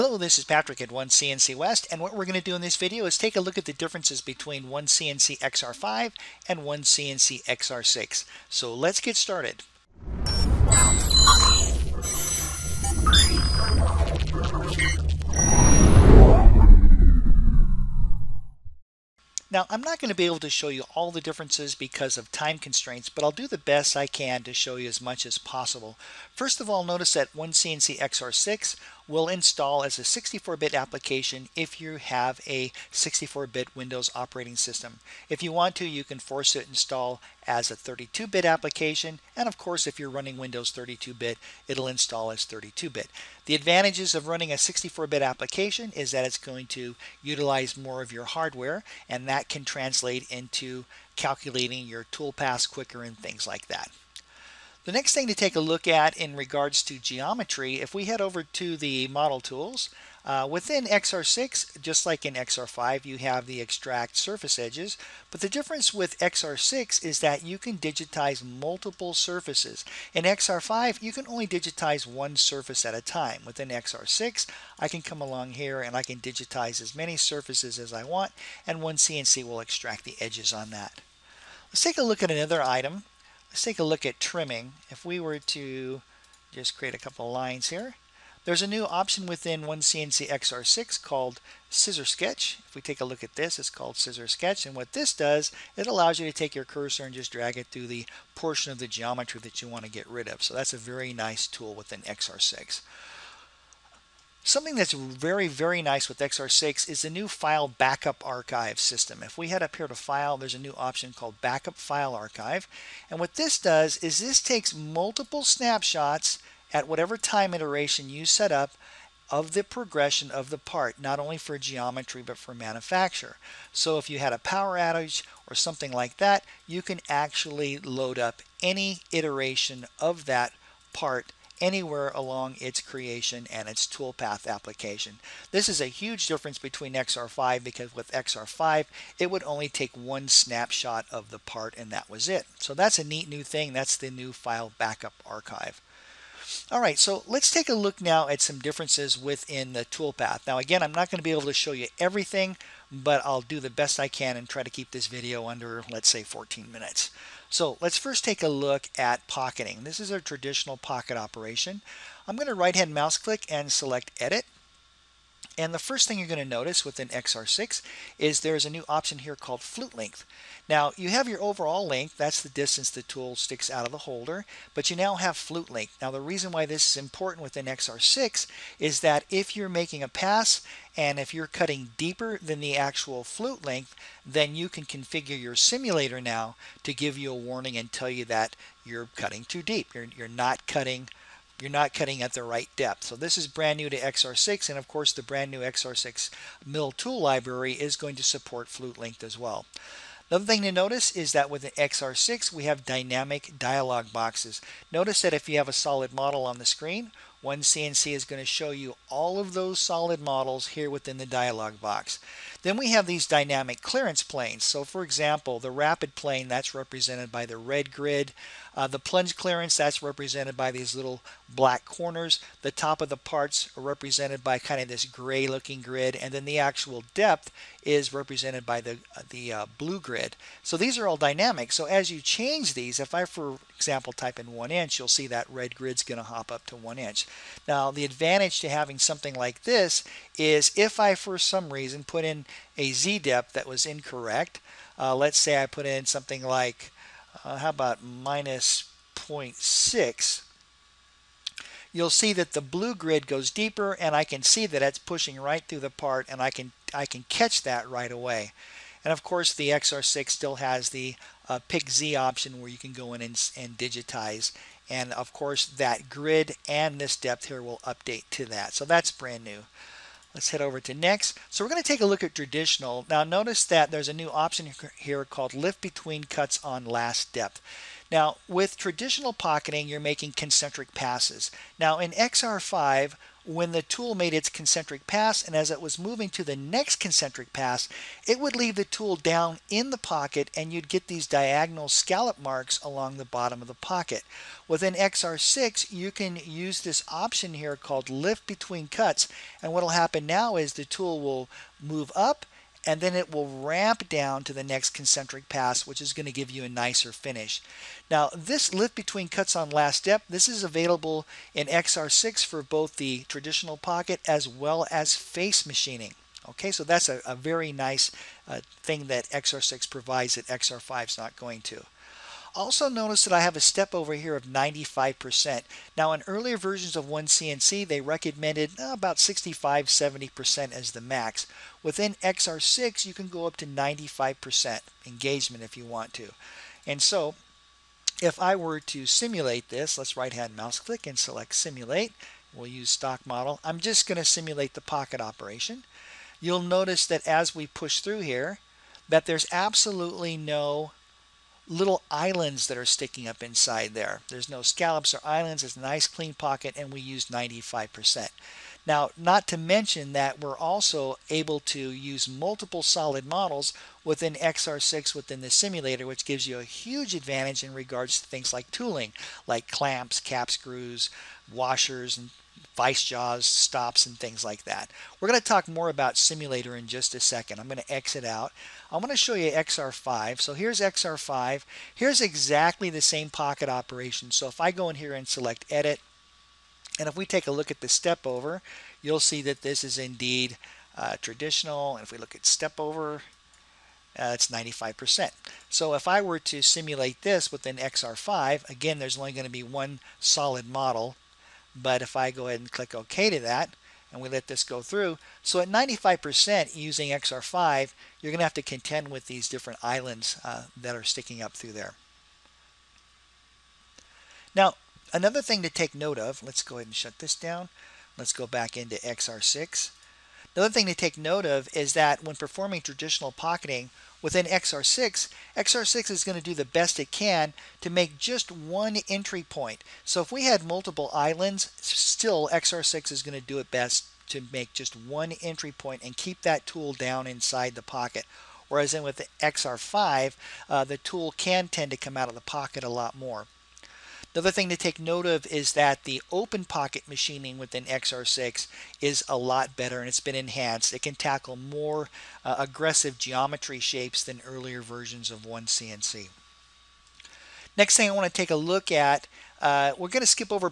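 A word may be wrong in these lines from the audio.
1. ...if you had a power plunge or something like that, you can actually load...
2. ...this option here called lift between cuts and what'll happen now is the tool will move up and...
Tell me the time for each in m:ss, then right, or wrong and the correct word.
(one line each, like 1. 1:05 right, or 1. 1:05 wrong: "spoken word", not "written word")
1. 2:03 wrong: "outage", not "plunge"
2. 4:56 right.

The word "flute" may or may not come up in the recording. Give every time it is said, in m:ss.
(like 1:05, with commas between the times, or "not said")
2:49, 2:55, 3:03, 3:18.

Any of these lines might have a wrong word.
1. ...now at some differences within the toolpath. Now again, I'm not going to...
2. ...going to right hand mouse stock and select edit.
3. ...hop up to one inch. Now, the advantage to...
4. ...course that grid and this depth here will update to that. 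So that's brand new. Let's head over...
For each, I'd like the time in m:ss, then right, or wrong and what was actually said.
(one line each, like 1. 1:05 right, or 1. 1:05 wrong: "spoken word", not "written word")
1. 2:28 right
2. 2:42 wrong: "click", not "stock"
3. 3:56 right
4. 4:25 right.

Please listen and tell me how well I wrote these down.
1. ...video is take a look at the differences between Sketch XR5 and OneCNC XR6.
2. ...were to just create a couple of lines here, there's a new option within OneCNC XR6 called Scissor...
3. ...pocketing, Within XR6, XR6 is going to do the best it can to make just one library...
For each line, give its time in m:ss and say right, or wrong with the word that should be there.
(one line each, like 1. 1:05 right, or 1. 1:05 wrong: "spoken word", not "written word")
1. 0:02 wrong: "OneCNC", not "Sketch"
2. 1:25 right
3. 7:03 wrong: "entry", not "library".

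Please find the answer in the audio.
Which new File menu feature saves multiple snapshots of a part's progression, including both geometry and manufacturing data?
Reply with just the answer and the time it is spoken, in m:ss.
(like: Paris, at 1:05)
Backup File Archive, at 1:51.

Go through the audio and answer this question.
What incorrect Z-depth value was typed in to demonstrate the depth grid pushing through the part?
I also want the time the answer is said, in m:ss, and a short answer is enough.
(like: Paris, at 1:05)
-0.6, at 4:08.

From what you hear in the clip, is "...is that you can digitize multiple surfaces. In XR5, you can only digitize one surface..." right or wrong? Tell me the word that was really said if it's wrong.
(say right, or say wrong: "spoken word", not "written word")
right.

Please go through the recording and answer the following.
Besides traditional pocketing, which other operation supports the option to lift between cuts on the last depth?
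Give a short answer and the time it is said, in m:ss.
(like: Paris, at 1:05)
Face machining, at 5:15.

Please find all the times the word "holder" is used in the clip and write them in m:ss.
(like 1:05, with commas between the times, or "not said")
2:53.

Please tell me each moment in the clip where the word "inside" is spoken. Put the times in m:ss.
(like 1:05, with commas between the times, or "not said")
5:53, 7:17.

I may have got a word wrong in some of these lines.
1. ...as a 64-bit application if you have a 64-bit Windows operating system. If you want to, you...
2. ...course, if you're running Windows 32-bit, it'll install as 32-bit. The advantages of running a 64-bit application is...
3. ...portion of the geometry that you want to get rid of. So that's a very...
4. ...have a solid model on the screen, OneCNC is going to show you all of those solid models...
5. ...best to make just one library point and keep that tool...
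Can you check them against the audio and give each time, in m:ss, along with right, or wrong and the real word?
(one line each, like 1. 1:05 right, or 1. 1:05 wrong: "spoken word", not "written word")
1. 0:29 right
2. 0:39 right
3. 1:38 right
4. 3:25 right
5. 7:13 wrong: "entry", not "library".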